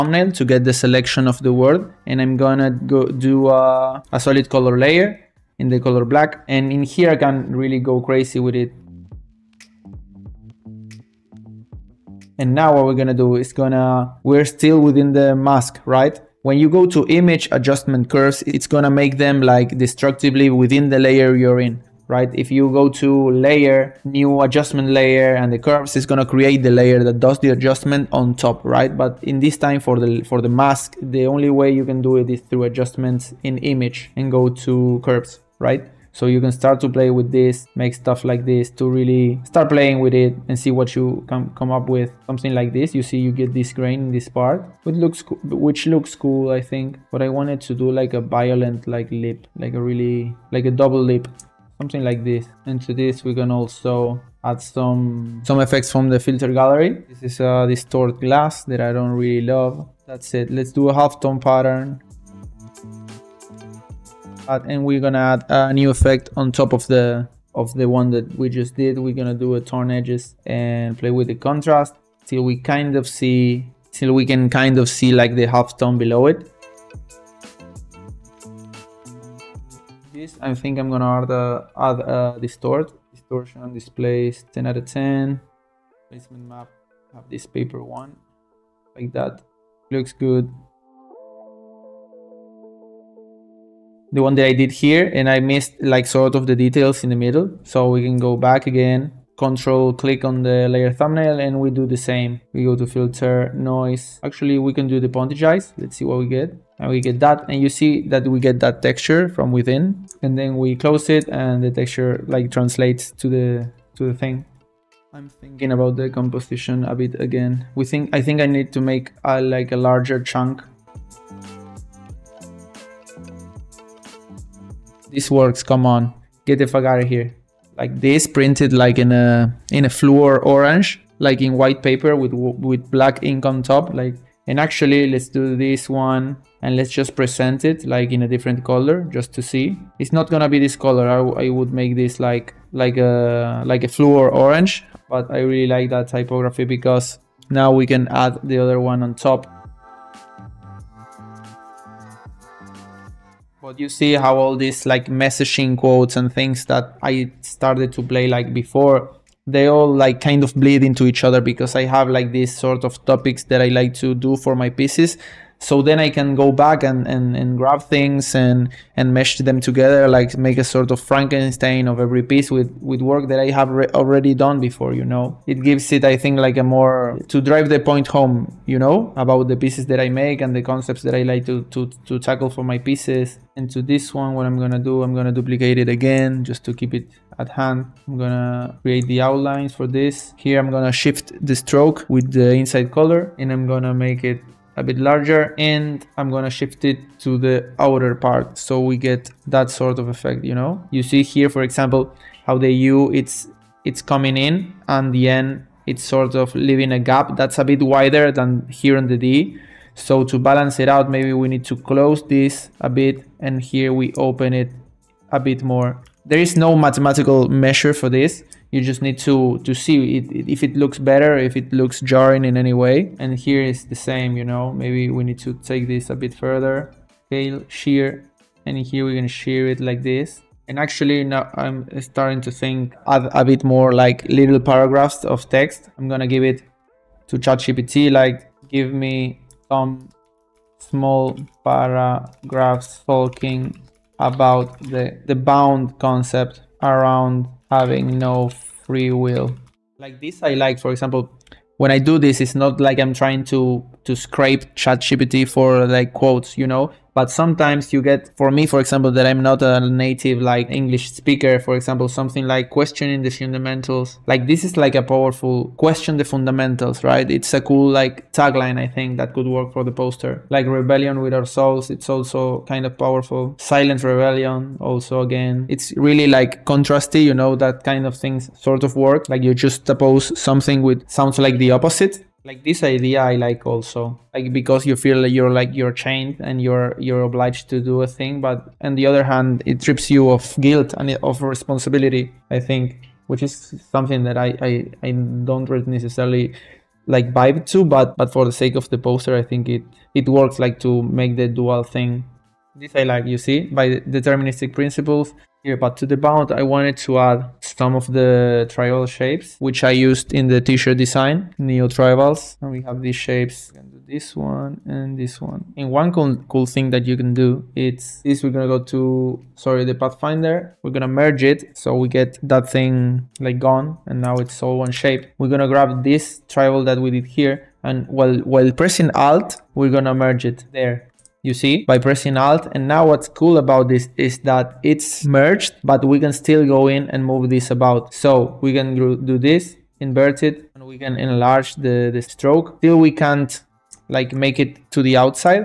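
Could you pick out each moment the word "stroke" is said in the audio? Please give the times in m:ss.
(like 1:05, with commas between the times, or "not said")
3:11, 5:42.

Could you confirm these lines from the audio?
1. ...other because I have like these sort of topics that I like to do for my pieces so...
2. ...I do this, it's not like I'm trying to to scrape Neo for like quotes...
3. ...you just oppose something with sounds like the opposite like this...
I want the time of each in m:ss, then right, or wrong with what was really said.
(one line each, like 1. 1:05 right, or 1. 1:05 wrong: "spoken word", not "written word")
1. 2:41 right
2. 4:11 wrong: "ChatGPT", not "Neo"
3. 4:39 right.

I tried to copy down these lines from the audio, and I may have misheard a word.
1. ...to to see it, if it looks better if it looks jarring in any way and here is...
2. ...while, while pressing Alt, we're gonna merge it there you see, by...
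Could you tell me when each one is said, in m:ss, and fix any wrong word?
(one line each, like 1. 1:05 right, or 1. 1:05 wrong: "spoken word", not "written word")
1. 3:39 right
2. 5:28 right.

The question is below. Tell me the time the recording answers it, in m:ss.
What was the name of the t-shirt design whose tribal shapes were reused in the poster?
5:11.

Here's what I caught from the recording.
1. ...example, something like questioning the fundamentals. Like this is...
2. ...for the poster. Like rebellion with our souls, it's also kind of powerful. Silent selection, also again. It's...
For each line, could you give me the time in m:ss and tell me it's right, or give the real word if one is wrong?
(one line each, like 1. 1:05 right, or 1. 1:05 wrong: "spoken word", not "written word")
1. 4:21 right
2. 4:29 wrong: "rebellion", not "selection".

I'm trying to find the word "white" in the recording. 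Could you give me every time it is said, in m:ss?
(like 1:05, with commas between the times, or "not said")
2:11.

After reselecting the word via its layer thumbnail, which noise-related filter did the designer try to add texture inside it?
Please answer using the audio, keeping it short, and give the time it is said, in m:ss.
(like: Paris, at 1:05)
pointillize, at 1:45.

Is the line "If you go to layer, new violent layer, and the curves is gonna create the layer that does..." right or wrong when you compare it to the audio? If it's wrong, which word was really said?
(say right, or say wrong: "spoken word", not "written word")
wrong: "adjustment", not "violent".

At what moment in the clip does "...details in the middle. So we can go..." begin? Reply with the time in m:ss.
1:36.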